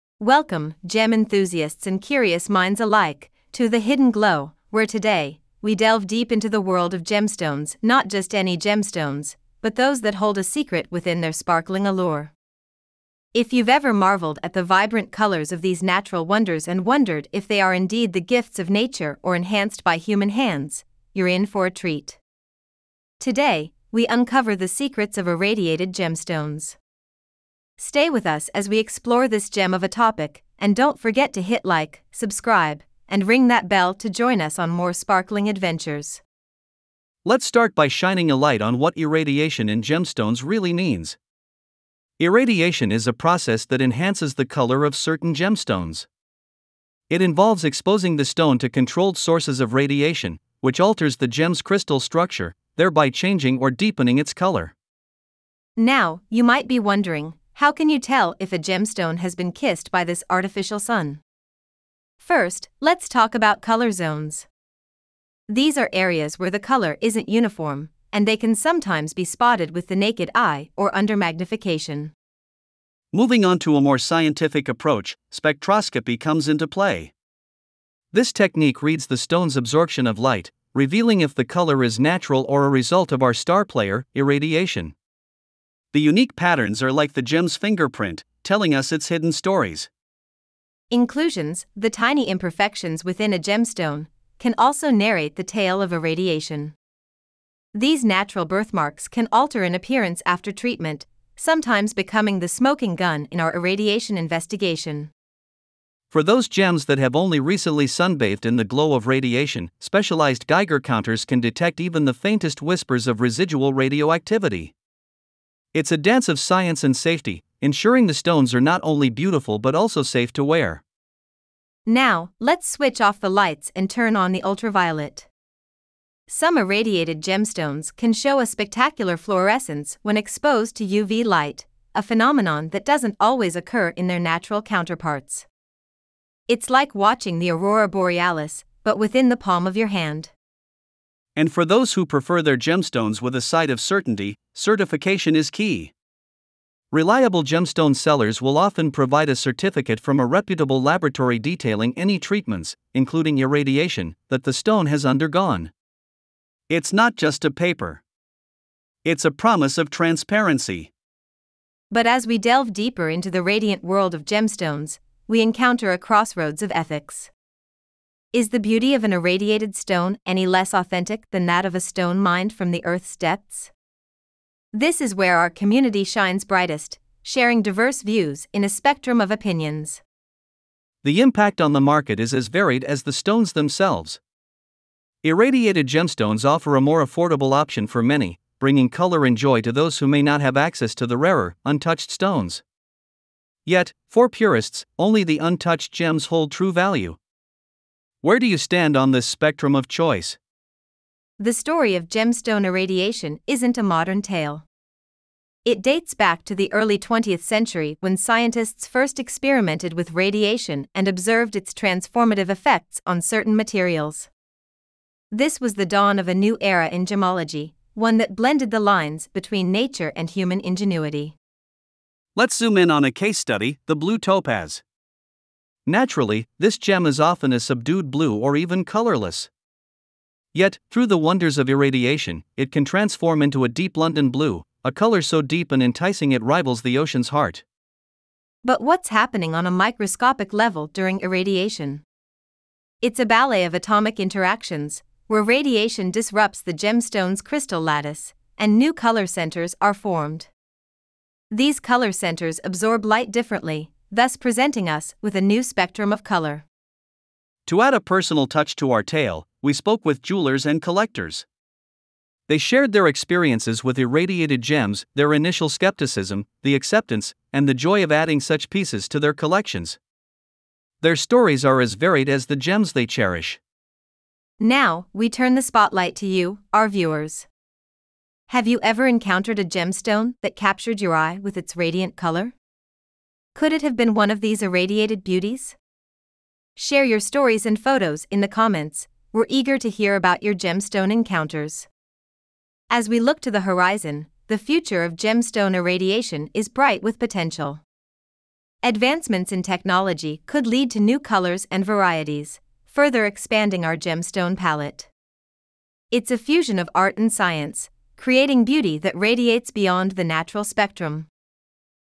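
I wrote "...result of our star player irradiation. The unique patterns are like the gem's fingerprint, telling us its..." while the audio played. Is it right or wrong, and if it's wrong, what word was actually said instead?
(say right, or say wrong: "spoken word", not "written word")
right.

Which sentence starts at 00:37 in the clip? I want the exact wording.
Let's start by shining a light on what irradiation in gemstones really means.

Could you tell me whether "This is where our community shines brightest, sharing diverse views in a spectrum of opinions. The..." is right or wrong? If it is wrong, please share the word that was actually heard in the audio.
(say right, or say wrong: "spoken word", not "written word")
right.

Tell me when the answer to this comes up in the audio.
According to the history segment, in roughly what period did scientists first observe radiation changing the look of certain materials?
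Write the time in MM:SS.
03:26.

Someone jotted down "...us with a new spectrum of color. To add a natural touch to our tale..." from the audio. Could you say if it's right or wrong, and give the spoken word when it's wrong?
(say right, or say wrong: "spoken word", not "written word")
wrong: "personal", not "natural".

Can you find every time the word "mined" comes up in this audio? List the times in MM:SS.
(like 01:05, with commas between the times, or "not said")
02:52.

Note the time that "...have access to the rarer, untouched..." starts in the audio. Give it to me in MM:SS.
03:10.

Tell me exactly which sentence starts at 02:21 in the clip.
And for those who prefer their gemstones with a side of certainty, certification is key.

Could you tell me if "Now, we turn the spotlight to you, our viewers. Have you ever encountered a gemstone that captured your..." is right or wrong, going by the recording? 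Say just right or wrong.
right.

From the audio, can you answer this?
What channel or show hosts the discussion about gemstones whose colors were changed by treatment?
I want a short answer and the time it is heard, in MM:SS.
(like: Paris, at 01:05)
The Hidden Glow, at 00:03.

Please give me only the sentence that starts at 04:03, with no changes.
It's a ballet of atomic interactions, where radiation disrupts the gemstone's crystal lattice, and new color centers are formed.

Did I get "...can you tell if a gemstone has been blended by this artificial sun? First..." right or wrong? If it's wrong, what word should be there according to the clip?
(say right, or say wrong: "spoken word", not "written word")
wrong: "kissed", not "blended".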